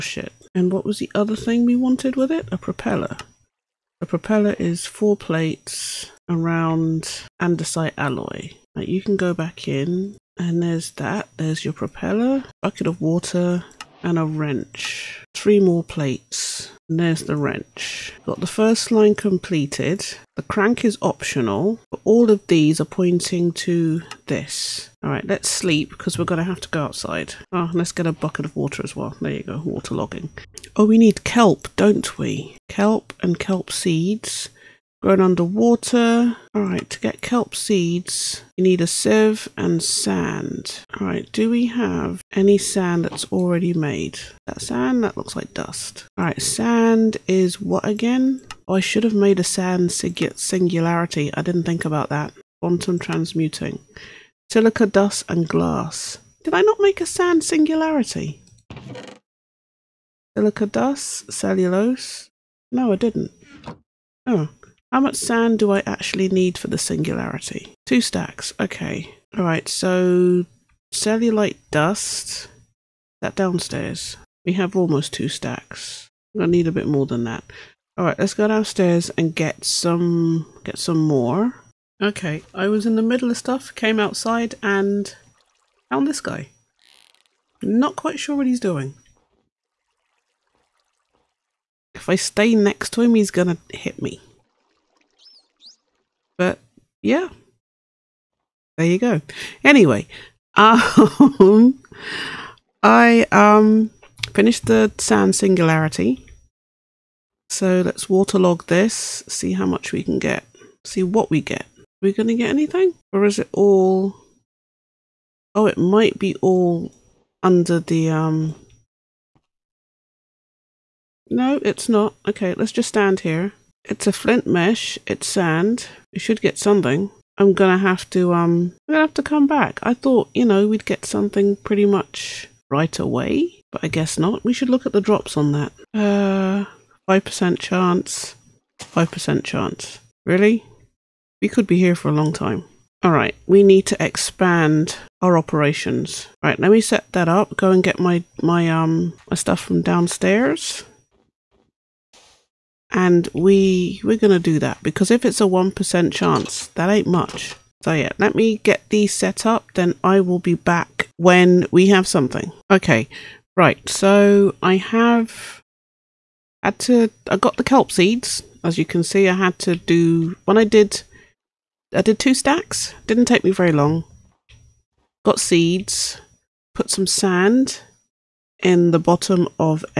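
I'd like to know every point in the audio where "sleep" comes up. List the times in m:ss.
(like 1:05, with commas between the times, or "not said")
0:25.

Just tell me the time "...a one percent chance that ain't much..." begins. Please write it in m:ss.
2:35.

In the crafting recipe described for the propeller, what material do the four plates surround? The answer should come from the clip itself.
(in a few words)
Andesite alloy.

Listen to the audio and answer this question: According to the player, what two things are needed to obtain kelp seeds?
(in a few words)
A sieve and sand.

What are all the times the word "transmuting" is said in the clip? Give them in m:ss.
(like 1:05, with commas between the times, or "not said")
0:52.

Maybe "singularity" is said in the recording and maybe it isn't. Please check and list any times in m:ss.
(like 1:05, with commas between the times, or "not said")
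0:49, 0:57, 1:06, 1:45.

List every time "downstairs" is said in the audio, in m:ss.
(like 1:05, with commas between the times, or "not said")
1:13, 1:18, 2:29.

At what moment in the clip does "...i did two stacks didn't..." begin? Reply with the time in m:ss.
2:51.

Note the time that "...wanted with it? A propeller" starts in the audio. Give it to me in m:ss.
0:01.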